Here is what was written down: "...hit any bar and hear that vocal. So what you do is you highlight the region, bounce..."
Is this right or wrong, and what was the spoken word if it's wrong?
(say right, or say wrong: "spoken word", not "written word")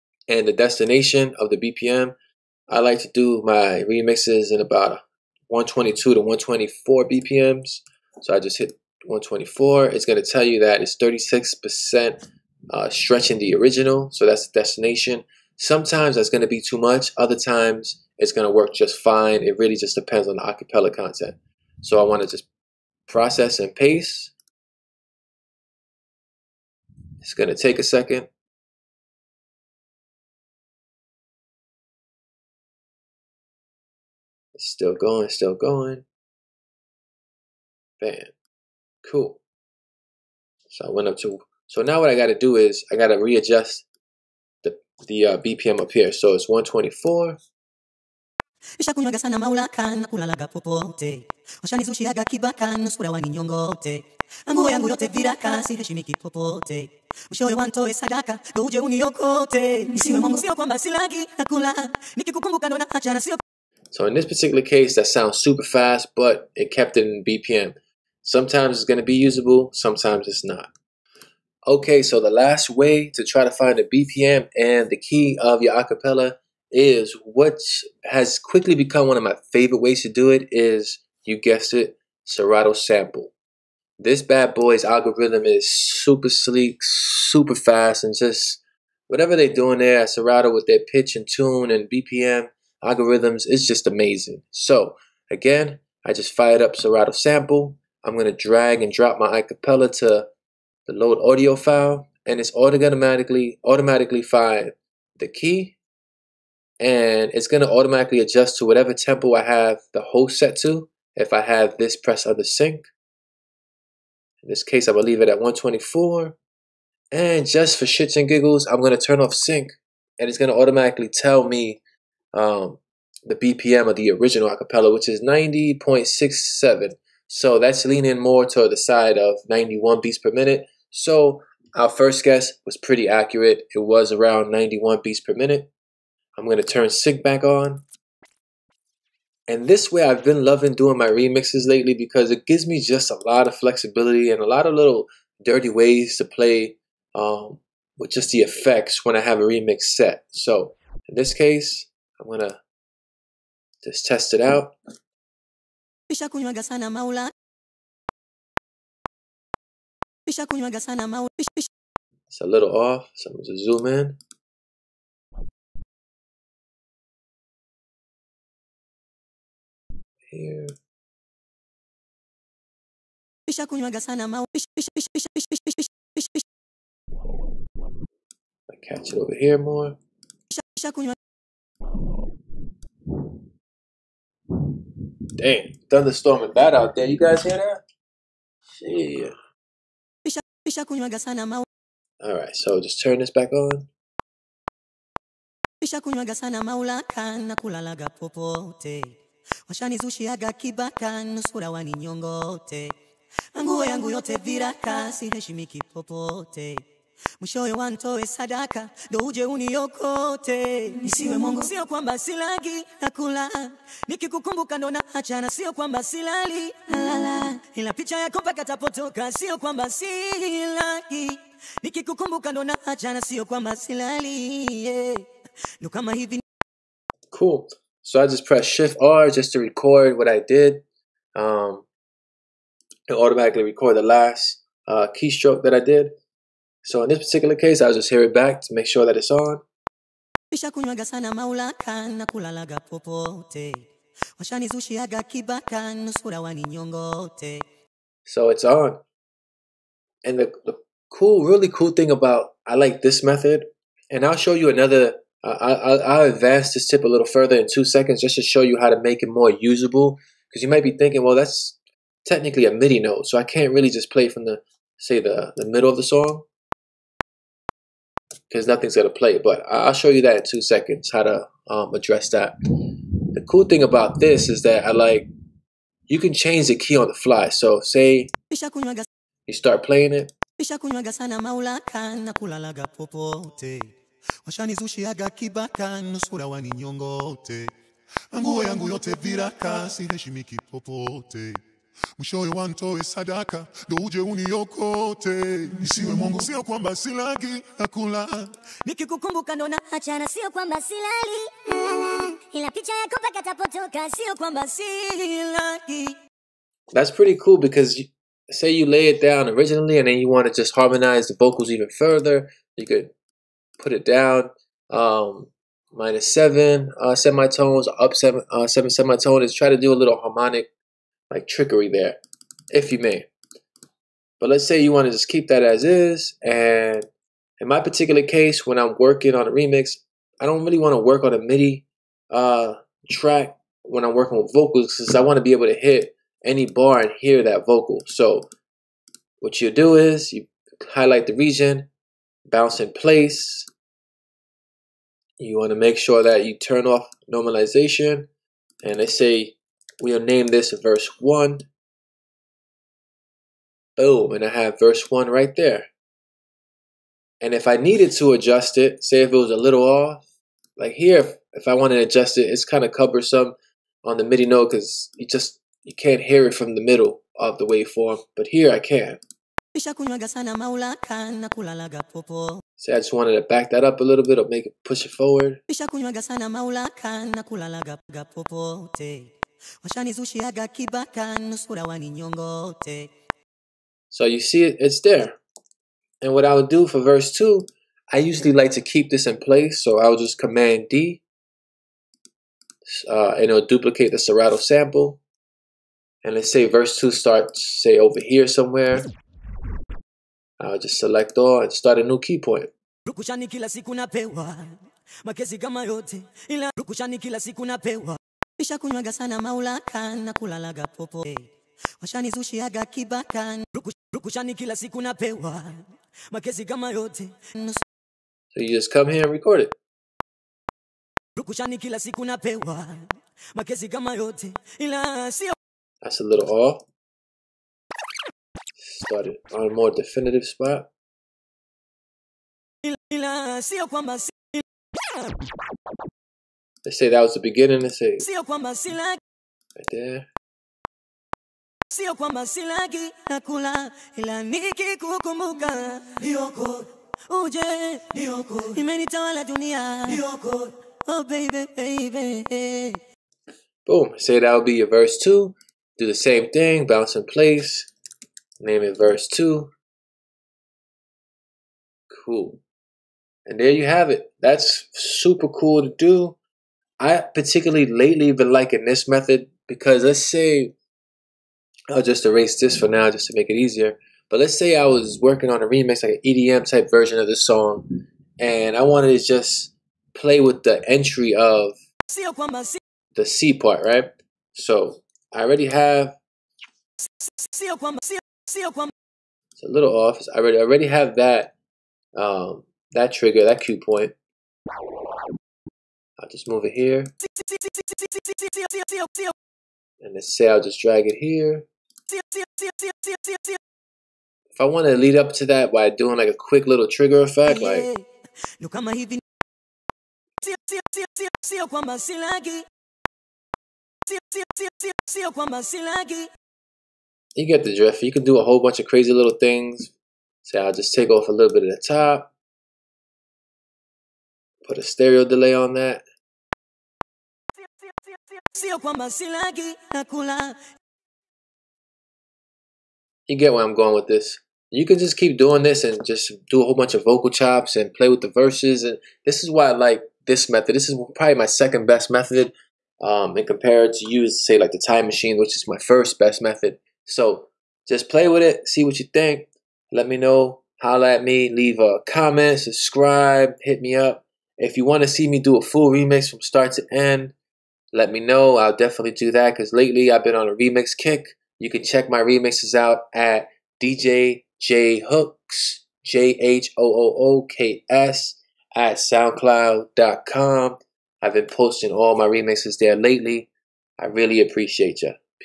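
right.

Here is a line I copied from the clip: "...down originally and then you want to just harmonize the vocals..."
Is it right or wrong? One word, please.
right.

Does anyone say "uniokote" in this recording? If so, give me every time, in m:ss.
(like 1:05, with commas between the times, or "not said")
0:58, 3:29, 4:54.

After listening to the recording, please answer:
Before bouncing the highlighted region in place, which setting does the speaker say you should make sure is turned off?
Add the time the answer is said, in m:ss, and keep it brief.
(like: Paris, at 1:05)
Normalization, at 5:47.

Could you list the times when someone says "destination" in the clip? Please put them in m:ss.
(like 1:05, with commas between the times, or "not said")
0:00, 0:14.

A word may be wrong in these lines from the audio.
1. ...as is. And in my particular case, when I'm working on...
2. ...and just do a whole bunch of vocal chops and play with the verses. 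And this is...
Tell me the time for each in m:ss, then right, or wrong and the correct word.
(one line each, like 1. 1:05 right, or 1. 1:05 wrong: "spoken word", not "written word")
1. 5:25 right
2. 8:55 right.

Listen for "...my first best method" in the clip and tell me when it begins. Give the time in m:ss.
9:05.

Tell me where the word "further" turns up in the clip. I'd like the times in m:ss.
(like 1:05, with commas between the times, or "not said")
4:17, 5:11.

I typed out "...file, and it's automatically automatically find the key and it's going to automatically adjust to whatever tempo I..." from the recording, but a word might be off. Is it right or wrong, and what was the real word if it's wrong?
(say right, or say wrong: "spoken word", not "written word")
right.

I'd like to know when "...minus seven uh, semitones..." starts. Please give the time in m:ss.
5:15.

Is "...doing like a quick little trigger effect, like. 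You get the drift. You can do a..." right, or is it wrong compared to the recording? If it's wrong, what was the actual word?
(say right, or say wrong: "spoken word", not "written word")
right.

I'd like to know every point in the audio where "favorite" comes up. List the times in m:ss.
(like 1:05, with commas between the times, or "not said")
1:19.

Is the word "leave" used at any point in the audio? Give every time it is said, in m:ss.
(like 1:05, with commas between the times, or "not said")
1:55, 9:11.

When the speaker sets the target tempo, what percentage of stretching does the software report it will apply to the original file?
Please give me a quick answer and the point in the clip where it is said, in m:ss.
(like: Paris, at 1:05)
36%, at 0:10.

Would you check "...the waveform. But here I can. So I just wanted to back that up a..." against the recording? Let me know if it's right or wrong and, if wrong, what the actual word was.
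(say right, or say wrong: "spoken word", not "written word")
right.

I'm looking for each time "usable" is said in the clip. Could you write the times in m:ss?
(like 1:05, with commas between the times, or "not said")
1:09, 4:19.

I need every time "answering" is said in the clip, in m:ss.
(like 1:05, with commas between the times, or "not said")
not said.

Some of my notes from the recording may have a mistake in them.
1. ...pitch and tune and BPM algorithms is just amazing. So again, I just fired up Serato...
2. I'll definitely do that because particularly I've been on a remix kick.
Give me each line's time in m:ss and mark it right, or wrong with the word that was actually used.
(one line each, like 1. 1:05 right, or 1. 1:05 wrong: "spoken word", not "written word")
1. 1:30 right
2. 9:18 wrong: "lately", not "particularly".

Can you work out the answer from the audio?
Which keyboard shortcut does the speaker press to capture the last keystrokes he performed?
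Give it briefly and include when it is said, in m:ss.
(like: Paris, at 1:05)
Shift R, at 3:48.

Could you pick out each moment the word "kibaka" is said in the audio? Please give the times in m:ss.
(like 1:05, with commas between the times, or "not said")
0:52, 3:20, 4:45.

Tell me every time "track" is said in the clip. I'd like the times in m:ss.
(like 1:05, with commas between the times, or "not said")
5:33.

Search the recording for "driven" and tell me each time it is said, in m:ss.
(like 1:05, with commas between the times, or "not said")
not said.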